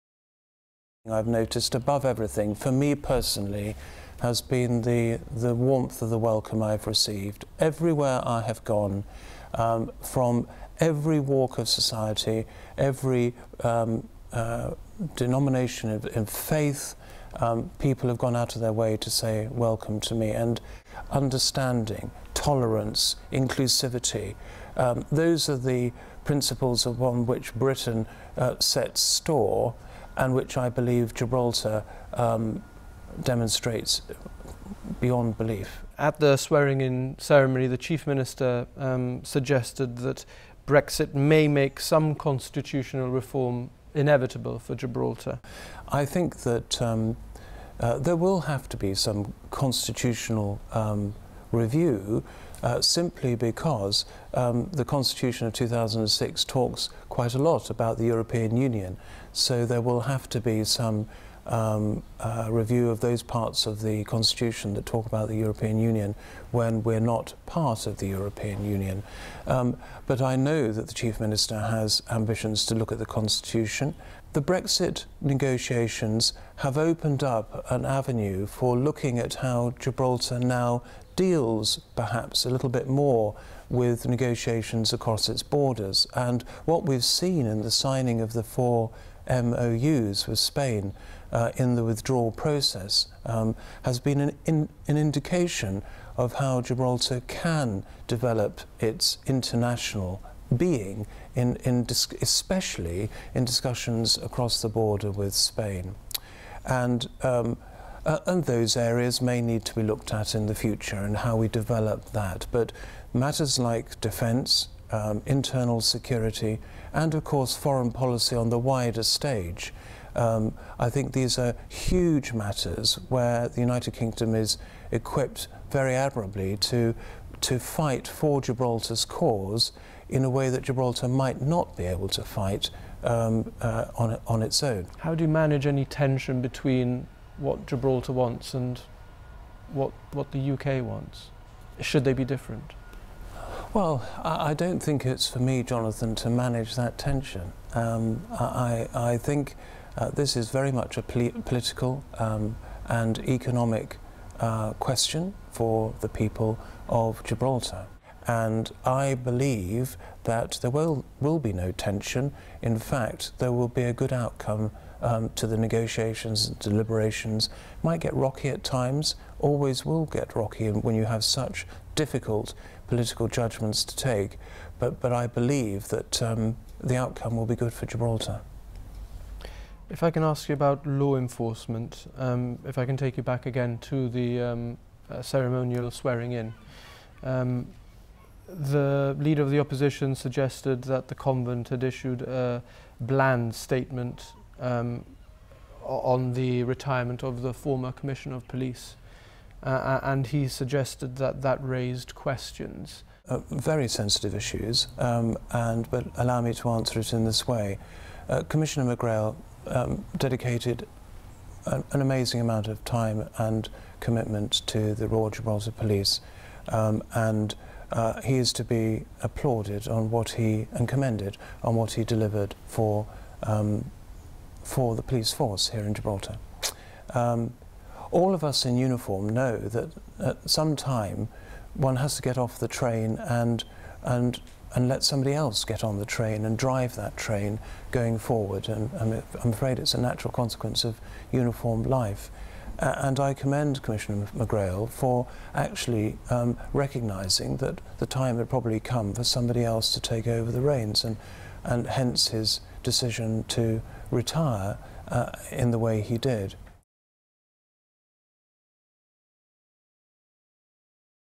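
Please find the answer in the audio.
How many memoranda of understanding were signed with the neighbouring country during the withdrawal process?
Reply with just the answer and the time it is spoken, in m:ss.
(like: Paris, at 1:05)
4, at 1:28.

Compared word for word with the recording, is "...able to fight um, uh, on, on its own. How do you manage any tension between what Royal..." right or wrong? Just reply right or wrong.
wrong.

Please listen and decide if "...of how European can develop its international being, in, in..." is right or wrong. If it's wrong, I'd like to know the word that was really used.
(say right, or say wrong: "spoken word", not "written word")
wrong: "Gibraltar", not "European".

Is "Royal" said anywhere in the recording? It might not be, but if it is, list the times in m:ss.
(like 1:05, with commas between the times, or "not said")
3:35.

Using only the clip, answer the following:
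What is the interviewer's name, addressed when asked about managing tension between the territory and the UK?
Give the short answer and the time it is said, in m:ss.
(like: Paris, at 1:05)
Jonathan, at 2:25.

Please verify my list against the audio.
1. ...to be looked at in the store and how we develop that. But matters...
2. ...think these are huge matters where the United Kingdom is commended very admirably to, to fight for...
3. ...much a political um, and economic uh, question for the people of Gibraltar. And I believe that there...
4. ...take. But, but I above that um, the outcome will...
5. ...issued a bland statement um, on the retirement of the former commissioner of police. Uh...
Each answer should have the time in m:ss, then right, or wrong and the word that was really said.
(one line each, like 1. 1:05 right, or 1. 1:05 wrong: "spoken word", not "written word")
1. 1:49 wrong: "future", not "store"
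2. 2:00 wrong: "equipped", not "commended"
3. 2:30 right
4. 2:53 wrong: "believe", not "above"
5. 3:11 right.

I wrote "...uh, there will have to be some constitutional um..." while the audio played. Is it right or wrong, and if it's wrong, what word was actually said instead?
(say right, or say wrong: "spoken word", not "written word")
right.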